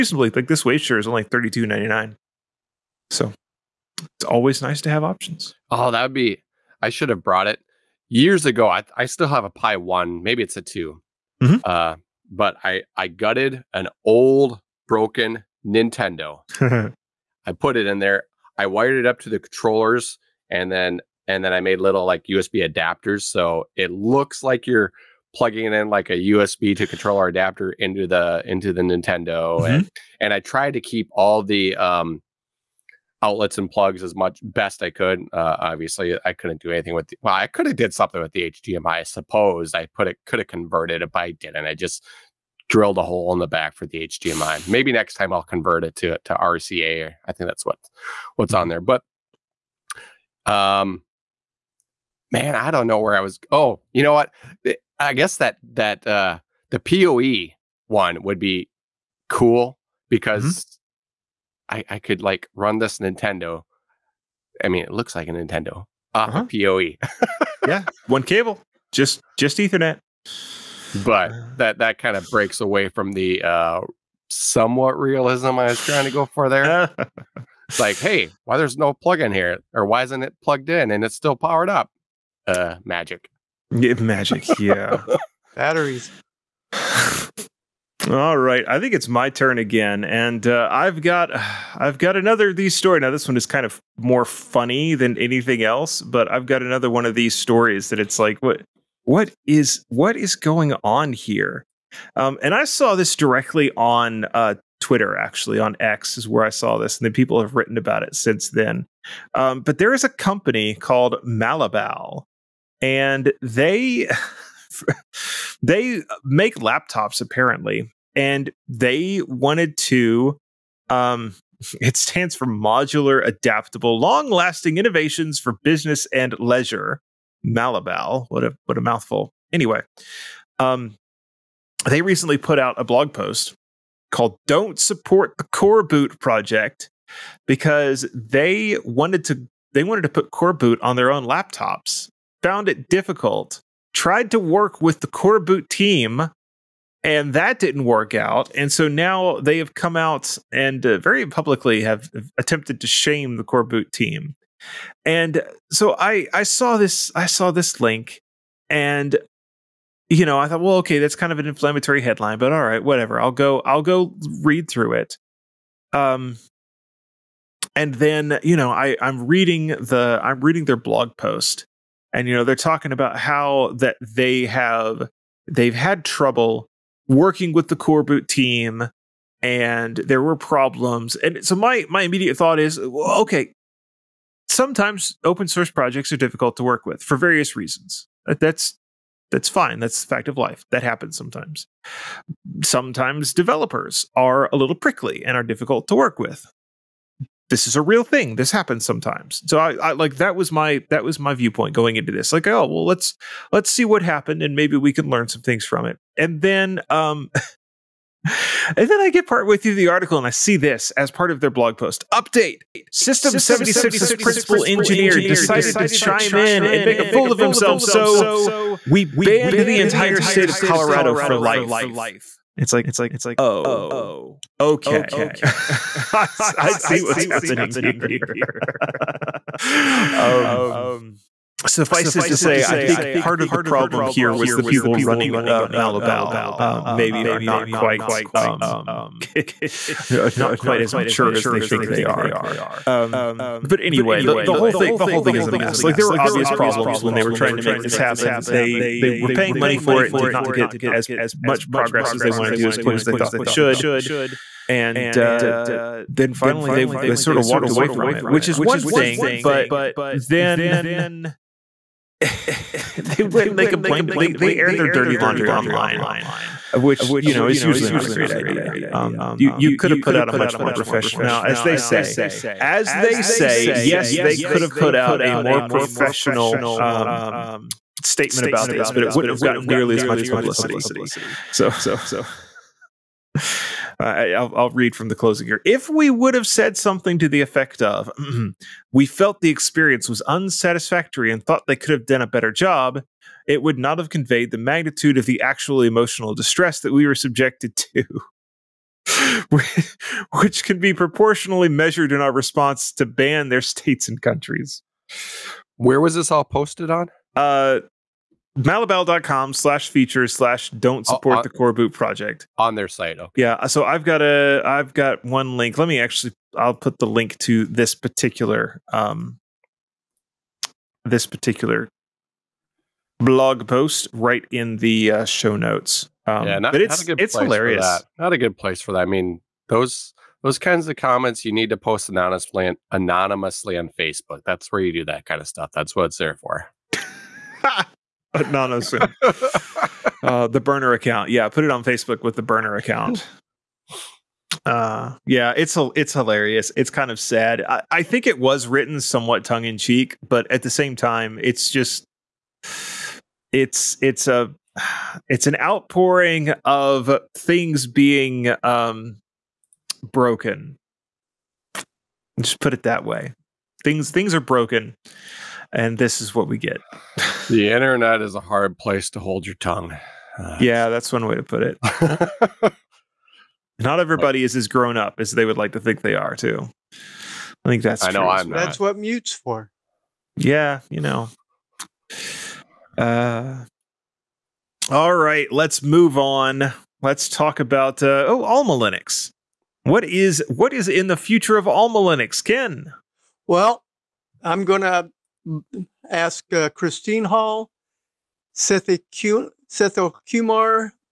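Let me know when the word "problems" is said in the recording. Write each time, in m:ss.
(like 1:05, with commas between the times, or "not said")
3:00, 3:53, 4:06.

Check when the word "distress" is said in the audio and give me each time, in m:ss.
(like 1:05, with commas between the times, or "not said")
4:56.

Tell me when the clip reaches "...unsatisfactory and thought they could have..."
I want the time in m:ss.
4:50.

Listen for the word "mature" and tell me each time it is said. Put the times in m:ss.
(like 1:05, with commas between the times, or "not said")
4:00.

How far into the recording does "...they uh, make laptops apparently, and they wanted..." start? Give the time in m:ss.
1:55.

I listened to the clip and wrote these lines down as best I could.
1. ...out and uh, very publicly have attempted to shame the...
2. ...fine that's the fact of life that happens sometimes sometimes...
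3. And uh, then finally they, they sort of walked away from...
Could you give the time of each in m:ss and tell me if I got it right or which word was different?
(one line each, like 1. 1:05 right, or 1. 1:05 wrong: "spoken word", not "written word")
1. 2:29 right
2. 3:09 right
3. 4:14 right.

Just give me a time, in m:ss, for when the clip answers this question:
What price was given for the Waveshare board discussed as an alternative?
0:01.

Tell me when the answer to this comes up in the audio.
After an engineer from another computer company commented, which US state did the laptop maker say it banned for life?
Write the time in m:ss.
3:40.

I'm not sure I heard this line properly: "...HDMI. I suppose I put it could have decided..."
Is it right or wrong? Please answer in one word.
wrong.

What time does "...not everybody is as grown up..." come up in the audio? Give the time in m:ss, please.
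6:13.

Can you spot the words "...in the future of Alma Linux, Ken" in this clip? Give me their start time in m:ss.
6:30.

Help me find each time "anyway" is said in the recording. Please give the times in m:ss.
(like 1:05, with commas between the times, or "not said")
2:09, 4:03.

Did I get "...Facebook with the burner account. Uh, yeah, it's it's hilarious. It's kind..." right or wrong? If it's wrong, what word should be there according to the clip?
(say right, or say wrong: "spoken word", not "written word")
right.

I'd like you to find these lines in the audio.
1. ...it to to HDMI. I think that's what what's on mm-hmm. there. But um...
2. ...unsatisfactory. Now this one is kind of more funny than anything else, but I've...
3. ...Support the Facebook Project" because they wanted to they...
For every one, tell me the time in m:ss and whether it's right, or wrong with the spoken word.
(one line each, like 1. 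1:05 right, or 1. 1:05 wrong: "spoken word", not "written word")
1. 0:45 wrong: "RCA", not "HDMI"
2. 1:32 wrong: "story", not "unsatisfactory"
3. 2:14 wrong: "Coreboot", not "Facebook".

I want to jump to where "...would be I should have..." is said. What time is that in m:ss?
0:06.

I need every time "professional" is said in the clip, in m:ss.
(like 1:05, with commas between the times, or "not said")
4:30, 4:35.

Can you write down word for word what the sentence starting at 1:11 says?
But that that kind of breaks away from the uh, somewhat realism I was trying to go for there.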